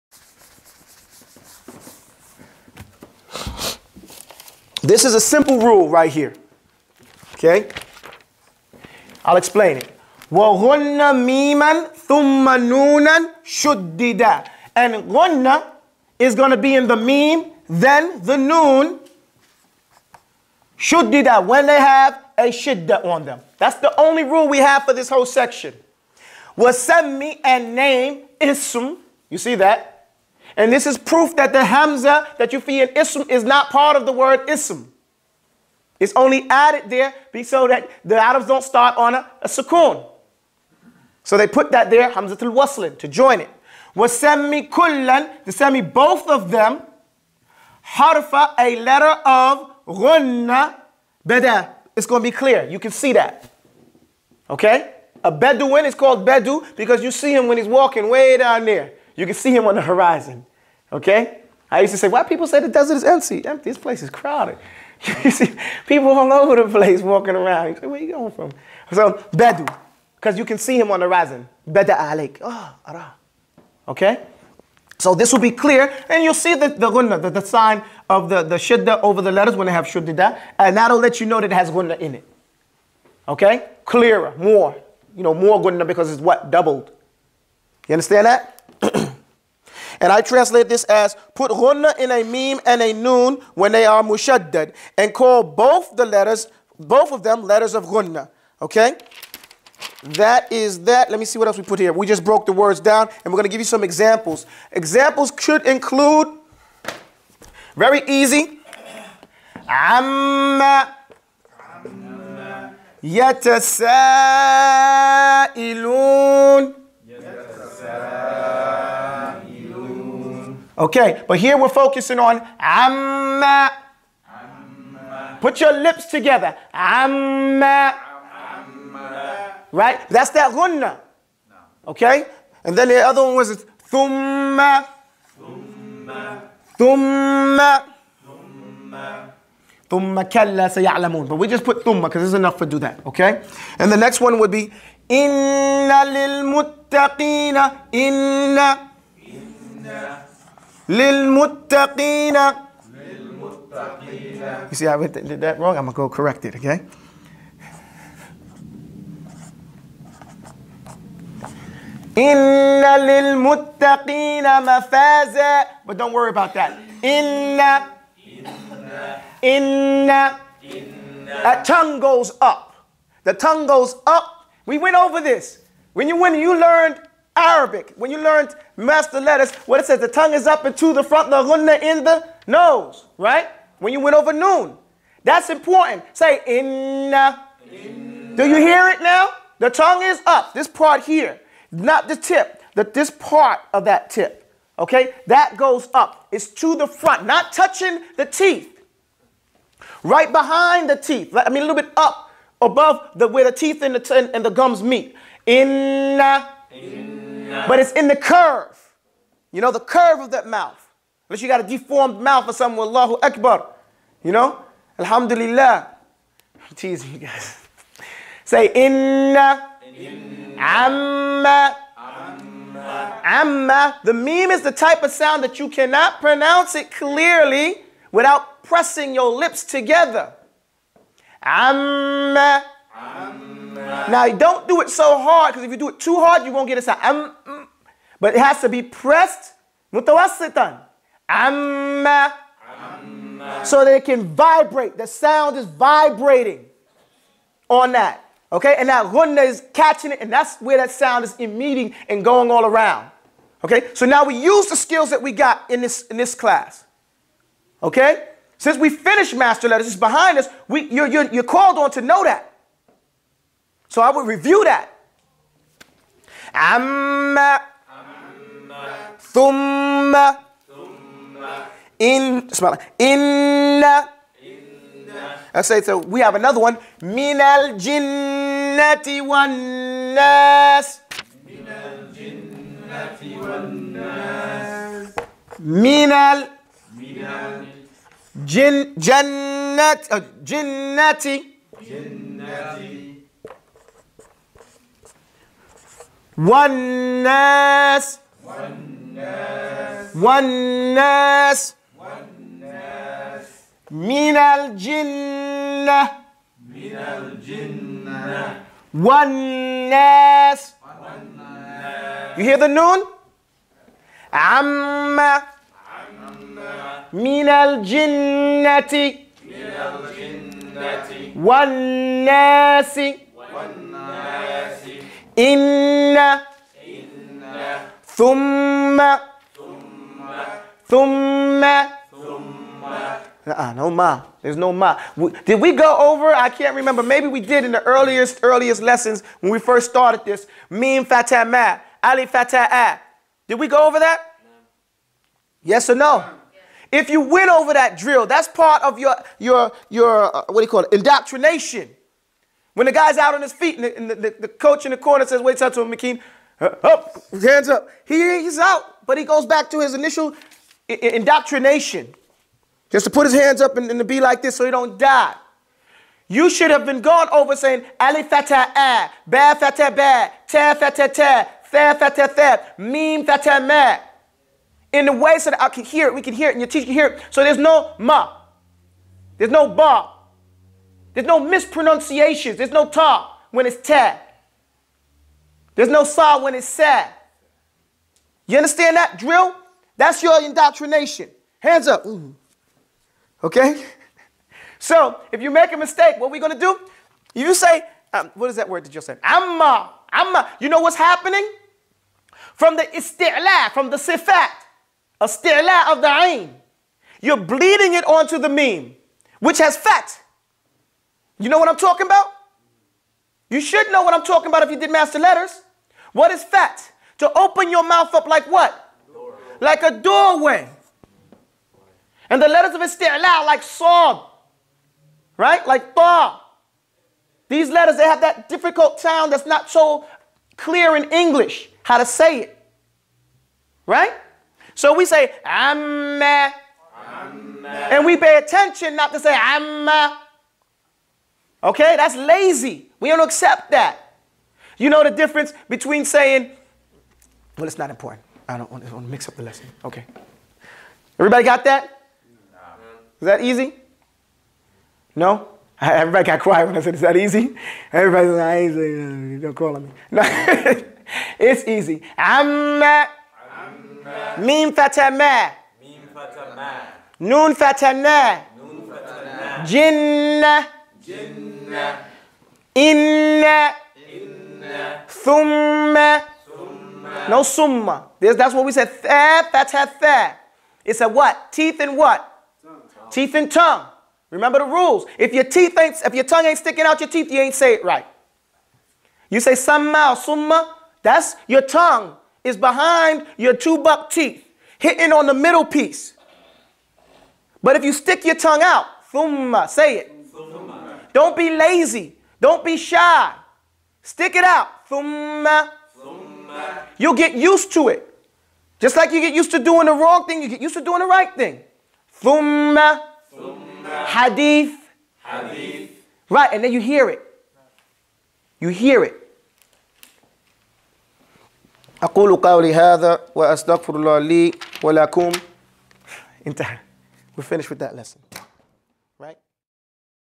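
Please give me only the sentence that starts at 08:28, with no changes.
Just like you get used to doing the wrong thing, you get used to doing the right thing.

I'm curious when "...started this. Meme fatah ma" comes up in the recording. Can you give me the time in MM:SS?
05:39.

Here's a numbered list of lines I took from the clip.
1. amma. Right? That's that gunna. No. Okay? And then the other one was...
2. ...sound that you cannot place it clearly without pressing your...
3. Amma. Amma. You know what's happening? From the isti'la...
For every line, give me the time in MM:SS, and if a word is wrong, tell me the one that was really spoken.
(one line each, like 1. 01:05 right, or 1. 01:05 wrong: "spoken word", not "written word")
1. 02:08 right
2. 03:45 wrong: "pronounce", not "place"
3. 06:39 right.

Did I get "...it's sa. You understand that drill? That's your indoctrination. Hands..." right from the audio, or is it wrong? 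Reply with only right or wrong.
right.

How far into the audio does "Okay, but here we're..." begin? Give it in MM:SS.
02:00.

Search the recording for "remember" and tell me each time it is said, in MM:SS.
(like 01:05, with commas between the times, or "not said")
05:36, 08:04.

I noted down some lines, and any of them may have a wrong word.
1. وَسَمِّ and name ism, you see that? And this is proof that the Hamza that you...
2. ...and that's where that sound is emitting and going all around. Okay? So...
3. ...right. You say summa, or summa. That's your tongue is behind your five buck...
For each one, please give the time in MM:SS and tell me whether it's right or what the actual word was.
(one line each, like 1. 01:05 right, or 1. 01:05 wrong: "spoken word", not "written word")
1. 00:26 right
2. 04:10 right
3. 08:07 wrong: "two", not "five".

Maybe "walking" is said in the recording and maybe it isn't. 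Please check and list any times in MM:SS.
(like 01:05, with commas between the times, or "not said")
00:57, 01:07.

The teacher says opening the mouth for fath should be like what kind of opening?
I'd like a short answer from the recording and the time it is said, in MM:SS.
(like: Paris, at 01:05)
A doorway, at 06:59.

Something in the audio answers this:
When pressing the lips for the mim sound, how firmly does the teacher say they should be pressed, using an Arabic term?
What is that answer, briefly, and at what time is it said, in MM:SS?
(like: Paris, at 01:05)
Mutawassitan, at 03:59.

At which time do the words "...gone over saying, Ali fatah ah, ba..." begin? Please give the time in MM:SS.
06:07.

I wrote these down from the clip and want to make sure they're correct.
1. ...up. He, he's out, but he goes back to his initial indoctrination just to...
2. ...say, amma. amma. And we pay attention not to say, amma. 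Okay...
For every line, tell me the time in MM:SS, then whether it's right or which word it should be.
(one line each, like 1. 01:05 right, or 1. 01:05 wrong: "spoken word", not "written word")
1. 05:57 right
2. 07:15 right.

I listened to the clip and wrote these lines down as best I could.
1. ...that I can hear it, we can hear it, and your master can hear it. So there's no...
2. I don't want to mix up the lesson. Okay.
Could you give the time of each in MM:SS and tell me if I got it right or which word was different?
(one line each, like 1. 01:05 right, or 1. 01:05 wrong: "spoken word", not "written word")
1. 06:15 wrong: "teacher", not "master"
2. 07:28 right.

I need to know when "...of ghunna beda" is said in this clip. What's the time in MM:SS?
00:49.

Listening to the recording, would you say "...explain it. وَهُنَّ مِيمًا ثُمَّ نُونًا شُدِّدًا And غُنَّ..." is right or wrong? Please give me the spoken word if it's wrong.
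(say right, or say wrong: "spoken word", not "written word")
right.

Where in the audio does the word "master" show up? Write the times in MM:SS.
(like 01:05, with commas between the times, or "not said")
02:58, 04:19, 06:54.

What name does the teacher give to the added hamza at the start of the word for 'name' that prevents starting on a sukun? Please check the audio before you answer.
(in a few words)
Hamzatul Waslin.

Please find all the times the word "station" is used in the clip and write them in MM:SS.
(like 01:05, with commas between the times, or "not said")
not said.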